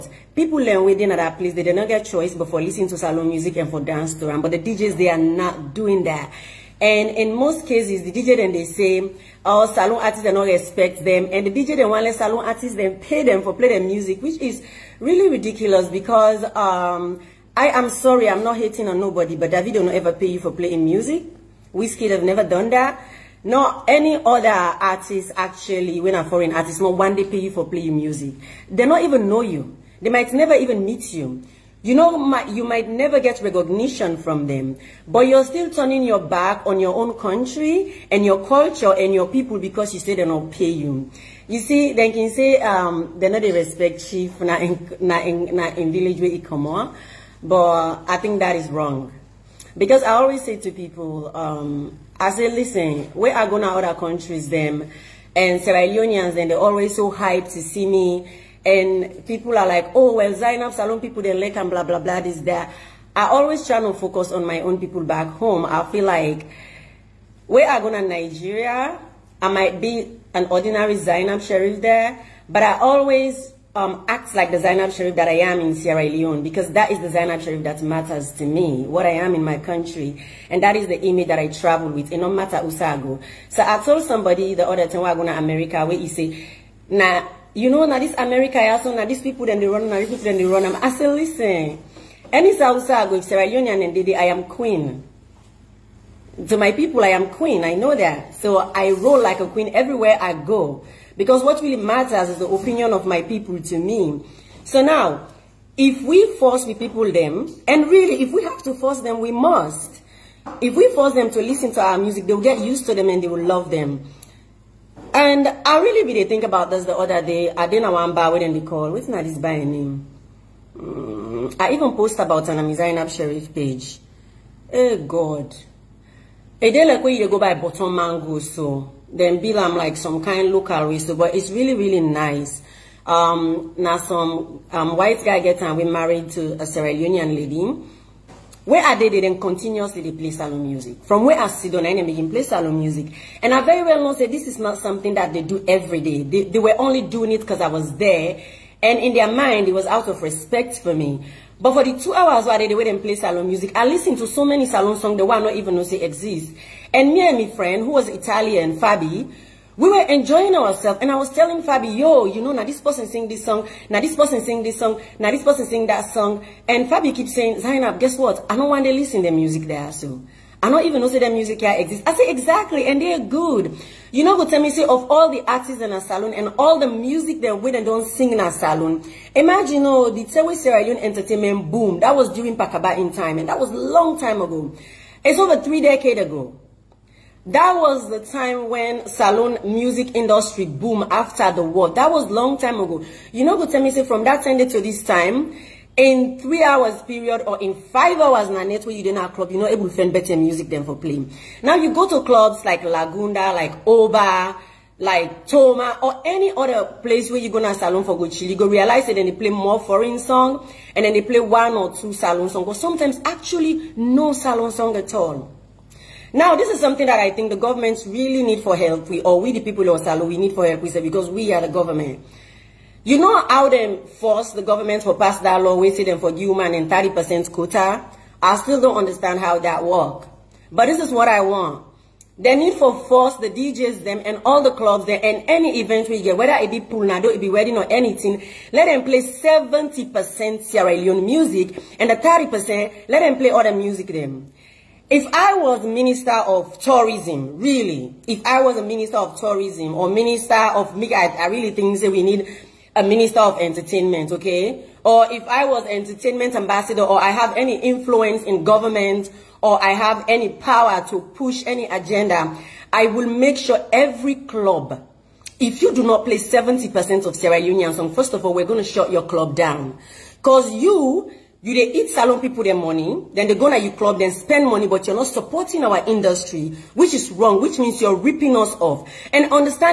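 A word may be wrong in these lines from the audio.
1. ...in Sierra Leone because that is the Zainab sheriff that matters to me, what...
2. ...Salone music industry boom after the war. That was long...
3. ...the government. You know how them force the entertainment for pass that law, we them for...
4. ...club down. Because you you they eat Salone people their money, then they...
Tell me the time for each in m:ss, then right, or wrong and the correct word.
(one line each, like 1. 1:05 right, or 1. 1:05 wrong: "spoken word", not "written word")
1. 1:15 right
2. 3:09 right
3. 3:41 wrong: "government", not "entertainment"
4. 4:29 right.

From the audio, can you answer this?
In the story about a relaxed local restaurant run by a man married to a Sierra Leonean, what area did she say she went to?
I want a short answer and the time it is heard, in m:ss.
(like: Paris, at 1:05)
Bottom Mango, at 2:07.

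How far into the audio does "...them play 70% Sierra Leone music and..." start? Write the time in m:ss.
3:58.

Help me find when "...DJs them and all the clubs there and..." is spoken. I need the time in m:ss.
3:53.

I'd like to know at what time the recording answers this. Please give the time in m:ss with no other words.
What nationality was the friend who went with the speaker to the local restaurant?
2:38.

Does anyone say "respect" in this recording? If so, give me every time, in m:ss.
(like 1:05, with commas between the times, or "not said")
0:10, 0:43, 2:30.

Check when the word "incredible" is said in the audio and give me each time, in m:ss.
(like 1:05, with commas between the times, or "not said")
not said.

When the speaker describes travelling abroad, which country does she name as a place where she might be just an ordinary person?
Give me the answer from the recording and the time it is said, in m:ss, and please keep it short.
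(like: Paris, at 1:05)
Nigeria, at 1:08.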